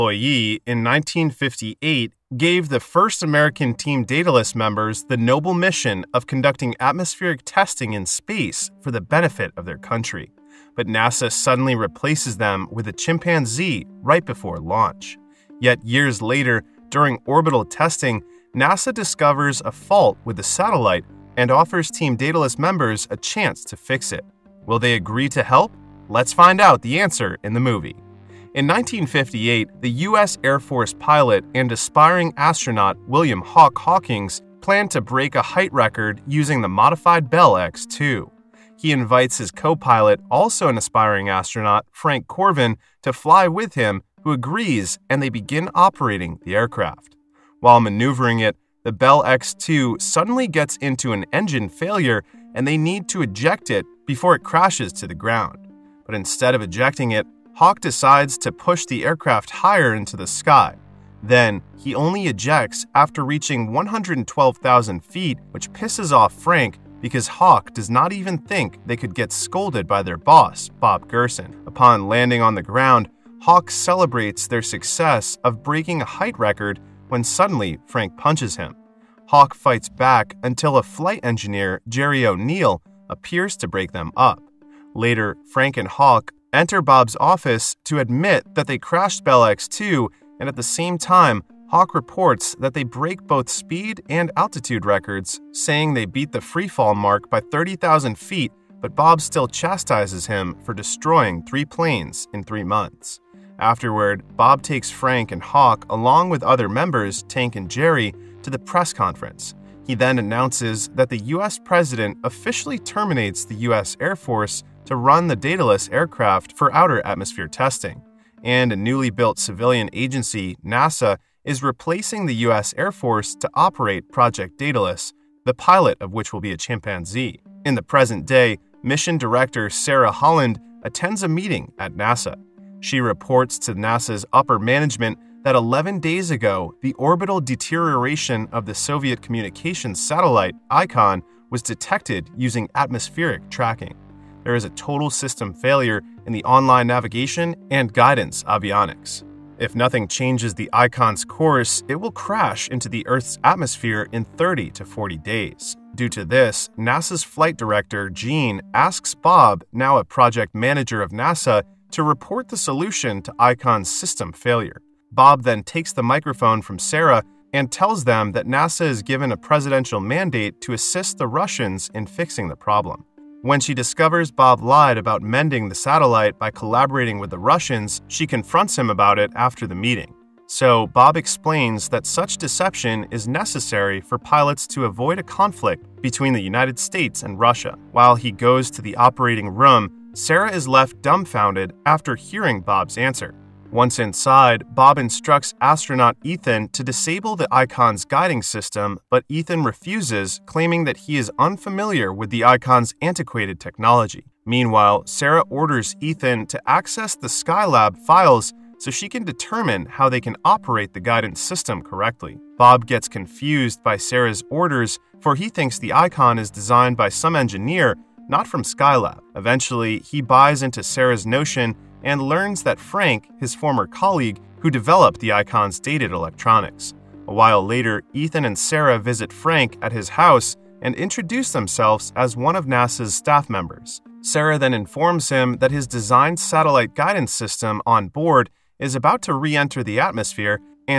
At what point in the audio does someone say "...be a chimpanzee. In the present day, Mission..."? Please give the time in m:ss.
2:06.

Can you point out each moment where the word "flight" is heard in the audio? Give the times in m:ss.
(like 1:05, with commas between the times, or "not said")
1:20, 2:37.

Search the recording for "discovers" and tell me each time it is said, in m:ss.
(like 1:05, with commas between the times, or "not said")
0:18, 2:53.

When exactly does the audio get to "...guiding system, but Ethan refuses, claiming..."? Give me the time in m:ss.
3:18.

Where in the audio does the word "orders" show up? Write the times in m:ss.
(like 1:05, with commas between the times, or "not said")
3:25, 3:34.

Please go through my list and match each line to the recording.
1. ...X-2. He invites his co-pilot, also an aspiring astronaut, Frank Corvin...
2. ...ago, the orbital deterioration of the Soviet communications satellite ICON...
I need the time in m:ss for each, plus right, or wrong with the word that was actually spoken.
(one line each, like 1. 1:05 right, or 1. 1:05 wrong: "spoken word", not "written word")
1. 0:37 right
2. 2:16 right.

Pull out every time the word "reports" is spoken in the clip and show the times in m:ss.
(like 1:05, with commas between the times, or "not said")
1:31, 2:13, 2:42.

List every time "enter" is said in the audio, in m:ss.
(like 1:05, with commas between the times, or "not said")
1:26, 3:59.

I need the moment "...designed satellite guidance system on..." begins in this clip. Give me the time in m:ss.
3:55.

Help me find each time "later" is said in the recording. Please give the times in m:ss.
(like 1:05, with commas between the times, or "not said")
0:16, 1:24, 3:47.